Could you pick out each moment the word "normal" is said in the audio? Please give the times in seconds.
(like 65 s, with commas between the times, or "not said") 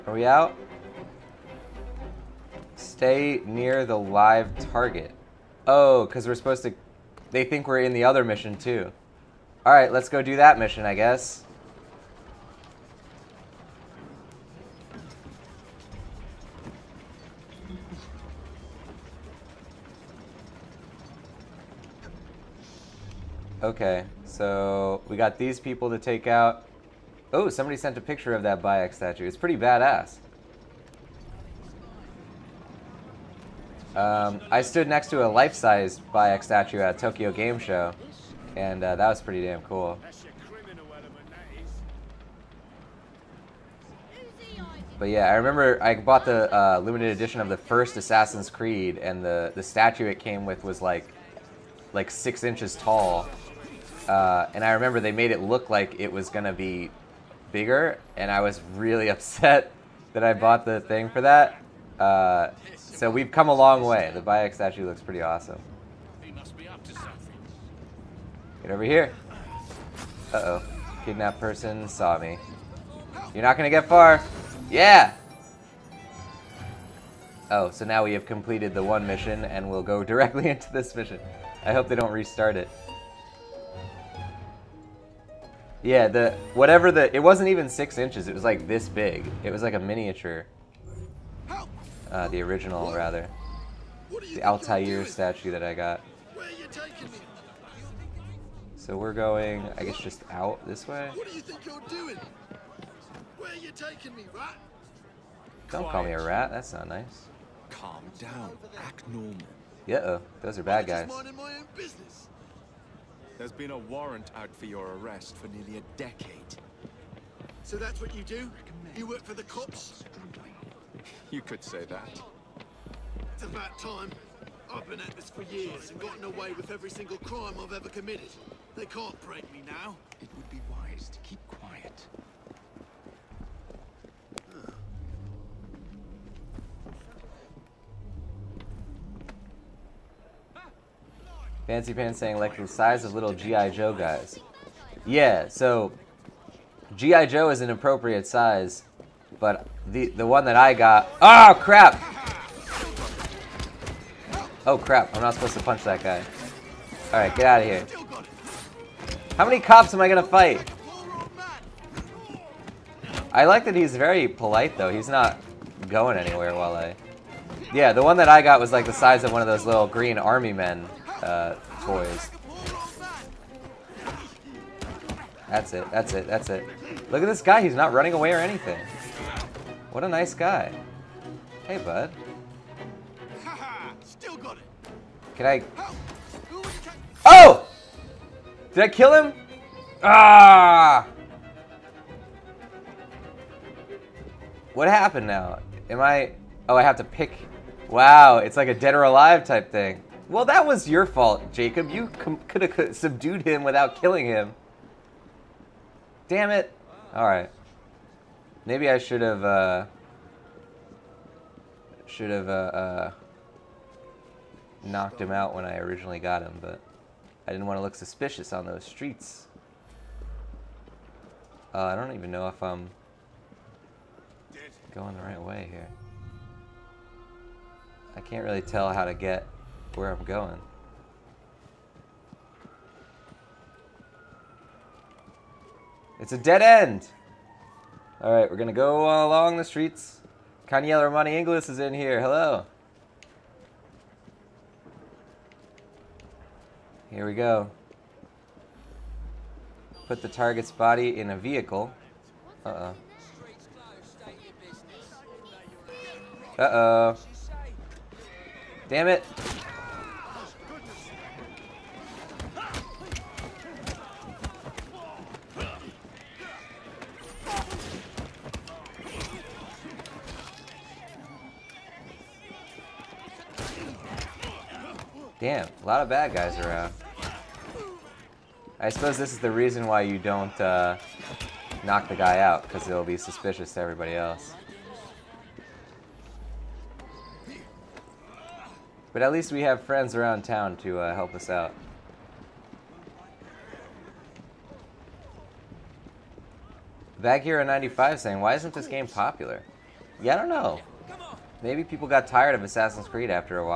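109 s.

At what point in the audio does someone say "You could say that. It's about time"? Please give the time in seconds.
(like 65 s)
121 s.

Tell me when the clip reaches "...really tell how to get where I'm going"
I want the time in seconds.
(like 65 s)
228 s.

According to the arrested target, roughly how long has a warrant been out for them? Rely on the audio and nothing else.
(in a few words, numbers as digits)
nearly a decade.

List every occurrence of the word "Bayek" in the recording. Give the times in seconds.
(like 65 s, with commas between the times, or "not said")
28 s, 36 s, 64 s.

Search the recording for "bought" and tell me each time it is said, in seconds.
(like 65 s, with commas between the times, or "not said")
45 s, 60 s.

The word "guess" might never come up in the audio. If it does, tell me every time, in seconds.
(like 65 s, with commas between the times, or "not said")
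10 s, 99 s.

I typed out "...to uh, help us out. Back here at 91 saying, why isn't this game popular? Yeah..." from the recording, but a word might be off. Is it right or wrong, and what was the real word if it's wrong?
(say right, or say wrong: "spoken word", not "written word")
wrong: "95", not "91".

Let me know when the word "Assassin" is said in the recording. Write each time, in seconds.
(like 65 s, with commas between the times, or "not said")
47 s, 302 s.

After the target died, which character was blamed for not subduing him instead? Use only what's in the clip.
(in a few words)
Jacob.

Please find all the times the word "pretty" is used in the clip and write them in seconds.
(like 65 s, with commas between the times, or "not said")
29 s, 39 s, 65 s.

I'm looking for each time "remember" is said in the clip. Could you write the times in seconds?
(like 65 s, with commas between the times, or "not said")
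45 s, 54 s.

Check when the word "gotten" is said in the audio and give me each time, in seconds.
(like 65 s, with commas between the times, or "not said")
125 s.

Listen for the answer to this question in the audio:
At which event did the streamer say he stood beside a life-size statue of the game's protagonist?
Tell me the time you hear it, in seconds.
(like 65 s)
36 s.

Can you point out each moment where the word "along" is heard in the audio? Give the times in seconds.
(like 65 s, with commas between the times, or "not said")
239 s.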